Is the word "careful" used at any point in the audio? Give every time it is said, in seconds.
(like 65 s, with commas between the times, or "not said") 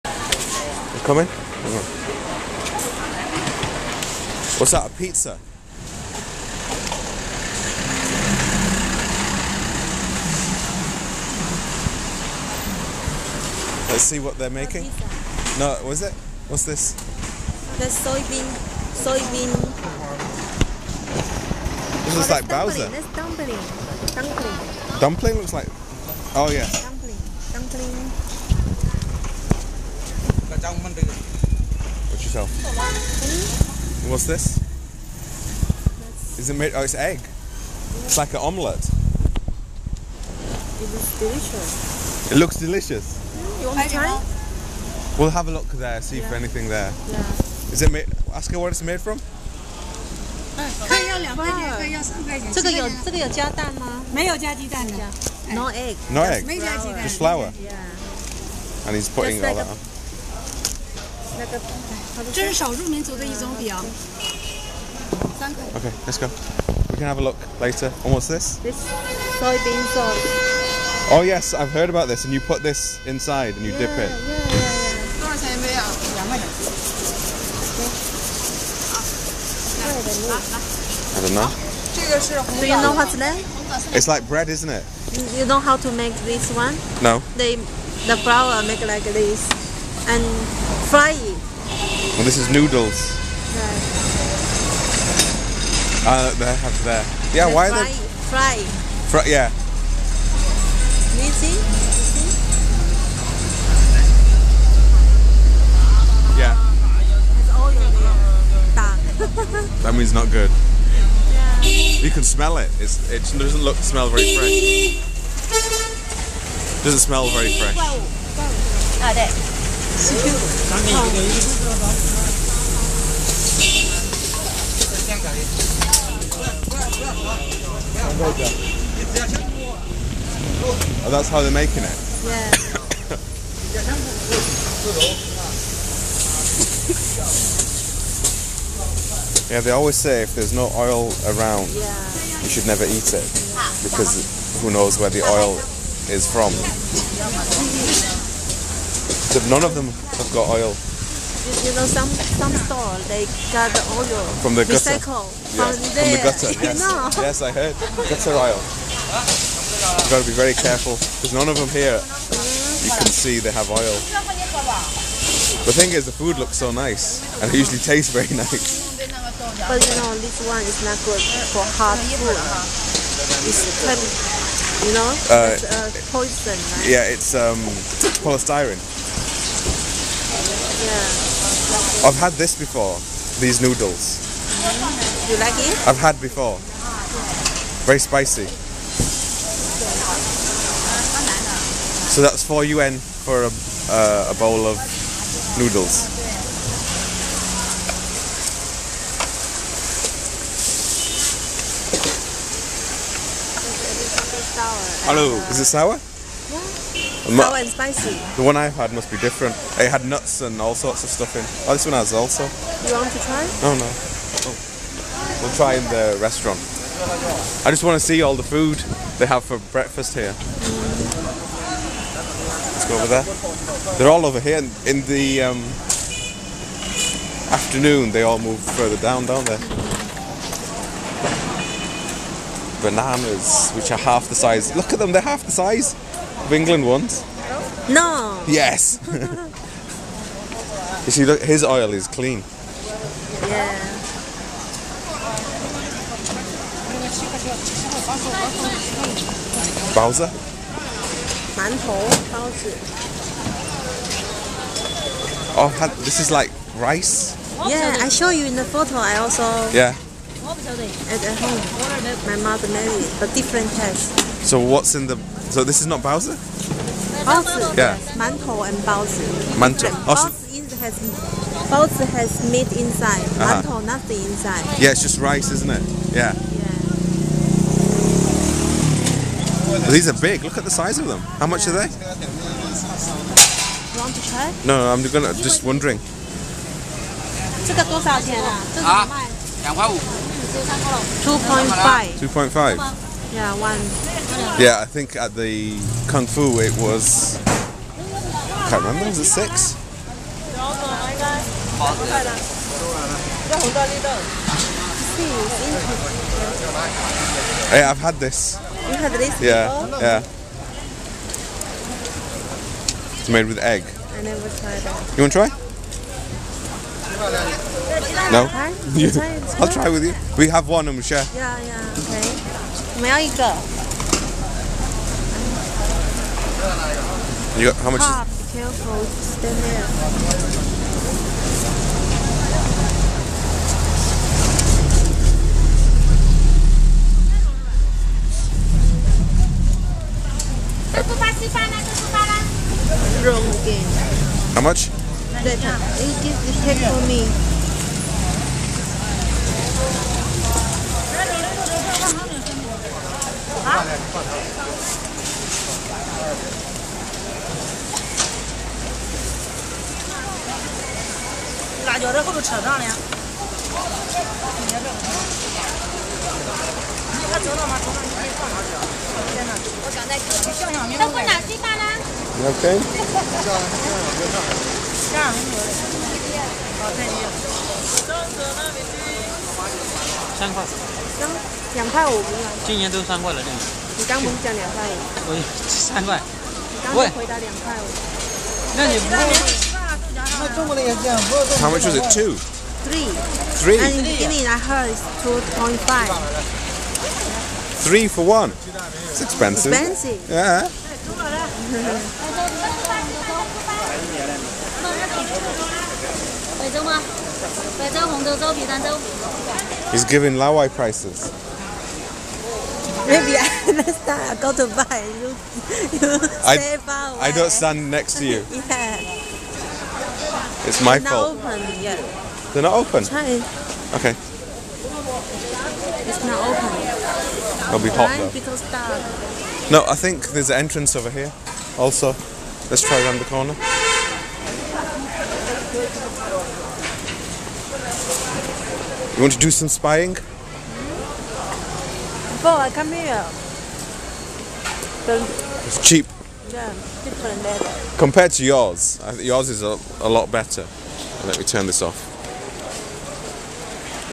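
160 s, 328 s.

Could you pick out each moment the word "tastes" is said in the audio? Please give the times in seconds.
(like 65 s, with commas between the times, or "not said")
167 s, 263 s.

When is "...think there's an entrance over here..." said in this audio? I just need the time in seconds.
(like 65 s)
429 s.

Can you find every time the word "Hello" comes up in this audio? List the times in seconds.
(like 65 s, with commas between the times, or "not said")
205 s.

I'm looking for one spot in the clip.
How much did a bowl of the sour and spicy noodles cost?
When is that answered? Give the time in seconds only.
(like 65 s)
192 s.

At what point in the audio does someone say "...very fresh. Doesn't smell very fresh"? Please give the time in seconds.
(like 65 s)
114 s.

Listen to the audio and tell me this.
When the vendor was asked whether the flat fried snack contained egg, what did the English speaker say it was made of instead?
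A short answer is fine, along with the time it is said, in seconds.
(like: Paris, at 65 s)
Just flour, at 57 s.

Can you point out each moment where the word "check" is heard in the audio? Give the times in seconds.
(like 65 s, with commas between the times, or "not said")
346 s.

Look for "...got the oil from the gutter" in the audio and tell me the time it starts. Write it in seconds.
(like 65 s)
153 s.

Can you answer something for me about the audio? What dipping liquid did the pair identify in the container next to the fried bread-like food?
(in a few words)
soybean sauce.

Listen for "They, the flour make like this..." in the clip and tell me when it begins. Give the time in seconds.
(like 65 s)
87 s.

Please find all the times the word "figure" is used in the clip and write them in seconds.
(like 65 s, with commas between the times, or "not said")
not said.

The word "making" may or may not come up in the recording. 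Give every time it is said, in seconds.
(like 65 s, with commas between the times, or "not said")
14 s, 131 s.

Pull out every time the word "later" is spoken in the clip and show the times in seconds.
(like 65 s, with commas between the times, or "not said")
67 s.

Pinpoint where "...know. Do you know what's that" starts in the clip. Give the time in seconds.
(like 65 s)
81 s.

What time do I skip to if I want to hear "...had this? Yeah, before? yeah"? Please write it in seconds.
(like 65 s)
308 s.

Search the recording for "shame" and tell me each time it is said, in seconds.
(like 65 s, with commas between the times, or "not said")
not said.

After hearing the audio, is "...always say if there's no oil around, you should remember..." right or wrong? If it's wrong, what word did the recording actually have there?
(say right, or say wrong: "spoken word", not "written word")
wrong: "never", not "remember".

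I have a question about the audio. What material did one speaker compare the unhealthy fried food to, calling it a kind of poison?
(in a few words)
polystyrene.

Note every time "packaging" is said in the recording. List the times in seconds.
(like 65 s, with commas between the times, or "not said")
not said.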